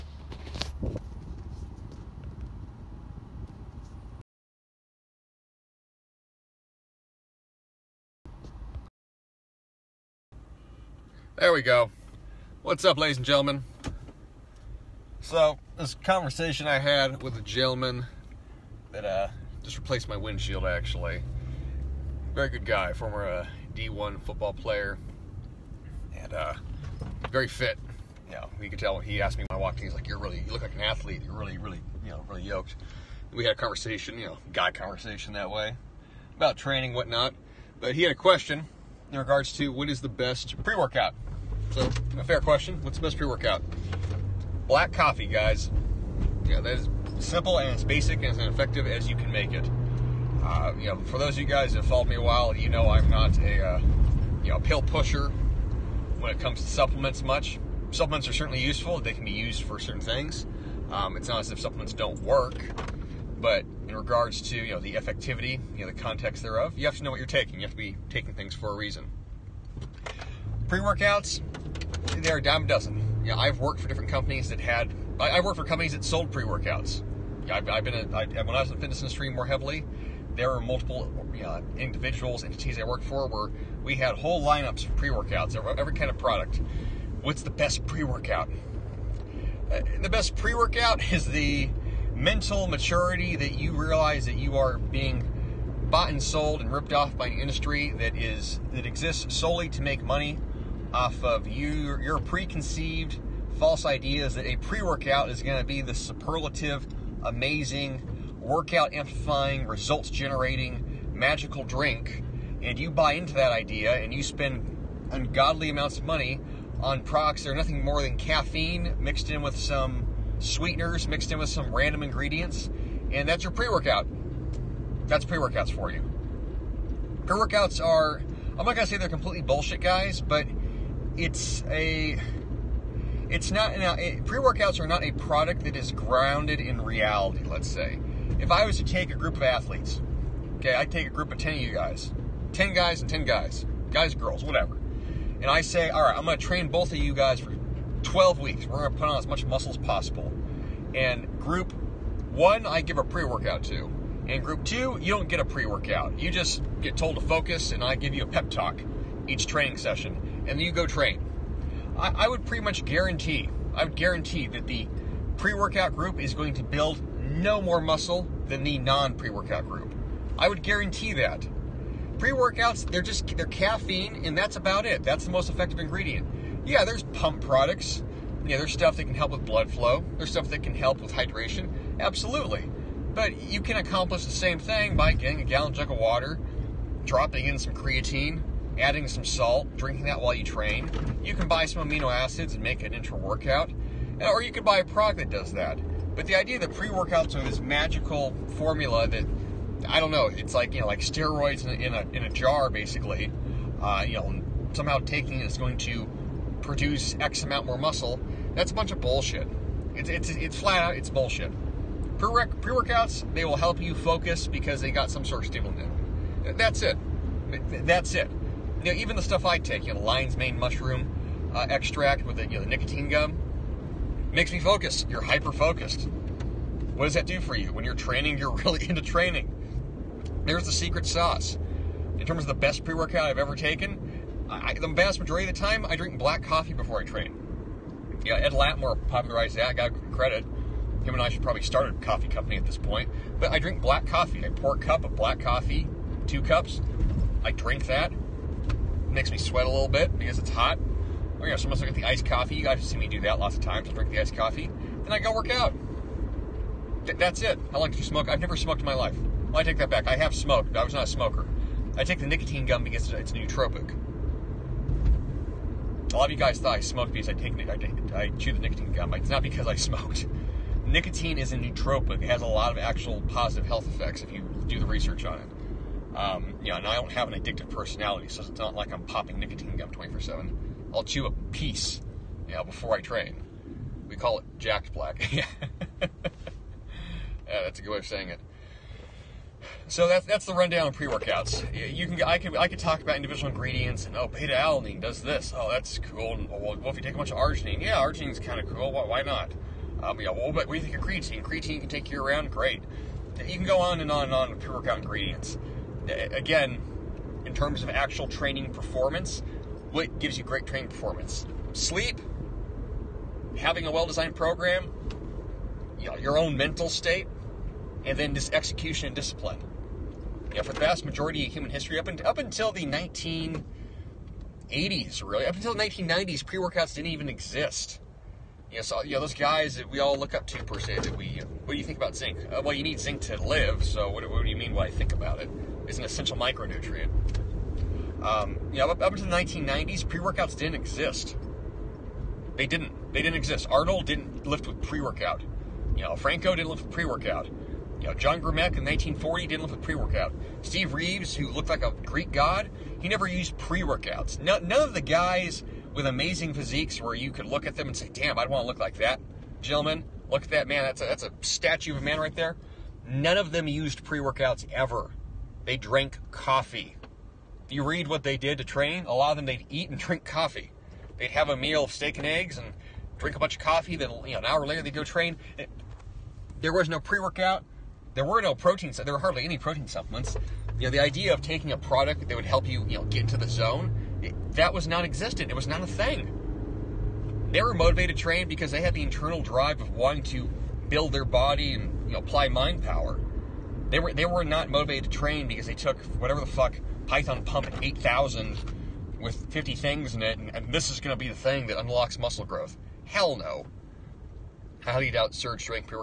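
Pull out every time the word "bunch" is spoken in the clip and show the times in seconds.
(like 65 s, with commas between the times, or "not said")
208 s, 297 s, 373 s.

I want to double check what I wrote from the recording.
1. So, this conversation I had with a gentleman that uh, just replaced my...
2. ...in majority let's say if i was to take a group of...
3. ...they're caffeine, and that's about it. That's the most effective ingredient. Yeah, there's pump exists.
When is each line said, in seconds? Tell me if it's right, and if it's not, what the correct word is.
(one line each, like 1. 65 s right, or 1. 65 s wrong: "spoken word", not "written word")
1. 15 s right
2. 136 s wrong: "reality", not "majority"
3. 173 s wrong: "products", not "exists".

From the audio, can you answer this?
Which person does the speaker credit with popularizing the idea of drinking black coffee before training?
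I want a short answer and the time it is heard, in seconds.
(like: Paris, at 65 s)
Ed Latimore, at 238 s.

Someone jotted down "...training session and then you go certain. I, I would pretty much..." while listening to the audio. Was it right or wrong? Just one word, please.
wrong.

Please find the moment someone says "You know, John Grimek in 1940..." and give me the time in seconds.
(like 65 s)
348 s.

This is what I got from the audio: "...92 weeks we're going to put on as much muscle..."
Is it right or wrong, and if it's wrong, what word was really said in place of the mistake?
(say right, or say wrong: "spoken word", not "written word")
wrong: "12", not "92".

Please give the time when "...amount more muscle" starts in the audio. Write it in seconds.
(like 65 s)
207 s.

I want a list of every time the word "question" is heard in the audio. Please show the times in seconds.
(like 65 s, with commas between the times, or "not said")
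38 s, 42 s.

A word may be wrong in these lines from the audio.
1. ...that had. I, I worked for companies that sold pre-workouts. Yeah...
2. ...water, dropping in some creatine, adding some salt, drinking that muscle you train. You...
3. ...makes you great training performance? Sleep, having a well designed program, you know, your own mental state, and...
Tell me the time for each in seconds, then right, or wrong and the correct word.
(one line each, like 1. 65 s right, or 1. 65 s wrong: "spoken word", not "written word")
1. 74 s right
2. 185 s wrong: "while", not "muscle"
3. 310 s wrong: "gives", not "makes".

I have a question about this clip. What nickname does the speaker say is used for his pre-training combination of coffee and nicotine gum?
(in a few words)
Jacked black.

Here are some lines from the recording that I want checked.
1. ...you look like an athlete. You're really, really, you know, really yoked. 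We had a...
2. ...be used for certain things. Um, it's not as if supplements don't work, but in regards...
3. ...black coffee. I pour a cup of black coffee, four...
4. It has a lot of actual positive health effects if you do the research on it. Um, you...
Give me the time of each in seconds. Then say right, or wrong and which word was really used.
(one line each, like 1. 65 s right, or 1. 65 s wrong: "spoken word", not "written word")
1. 30 s right
2. 59 s right
3. 243 s wrong: "two", not "four"
4. 272 s right.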